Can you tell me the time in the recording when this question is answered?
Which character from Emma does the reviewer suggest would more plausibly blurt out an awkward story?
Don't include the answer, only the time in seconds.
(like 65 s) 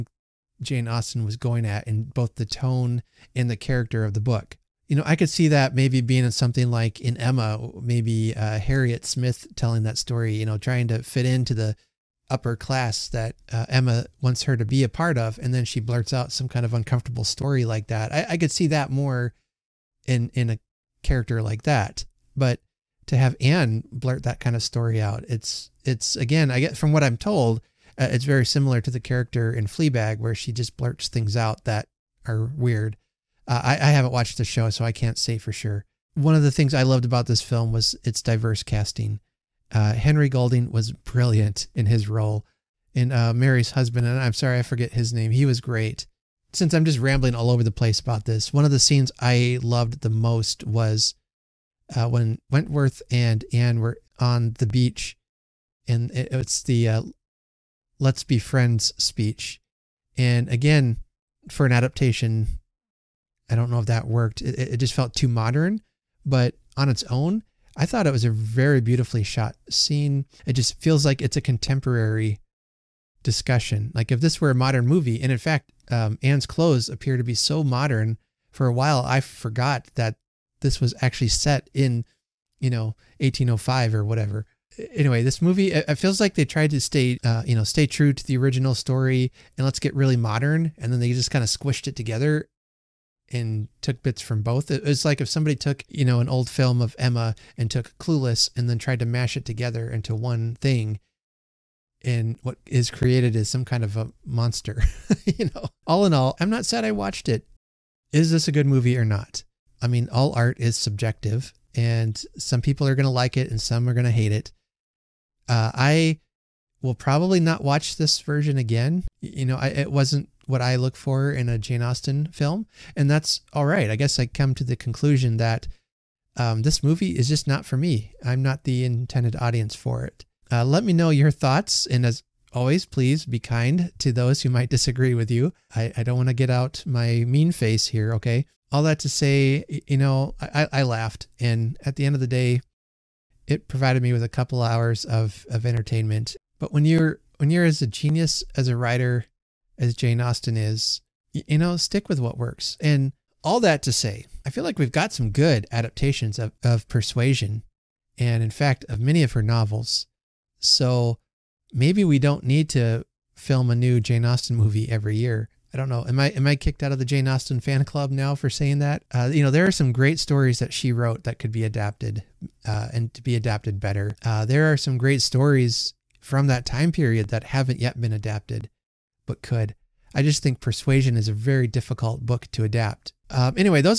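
8 s.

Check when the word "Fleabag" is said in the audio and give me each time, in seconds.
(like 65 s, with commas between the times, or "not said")
29 s.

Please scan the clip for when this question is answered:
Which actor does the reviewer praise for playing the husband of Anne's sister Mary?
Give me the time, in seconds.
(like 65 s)
39 s.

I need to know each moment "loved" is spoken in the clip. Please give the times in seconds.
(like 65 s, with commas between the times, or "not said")
36 s, 49 s.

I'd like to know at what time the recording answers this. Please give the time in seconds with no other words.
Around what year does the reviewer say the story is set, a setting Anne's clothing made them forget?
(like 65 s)
83 s.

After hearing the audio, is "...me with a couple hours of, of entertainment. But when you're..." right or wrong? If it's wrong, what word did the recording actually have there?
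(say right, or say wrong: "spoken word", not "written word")
right.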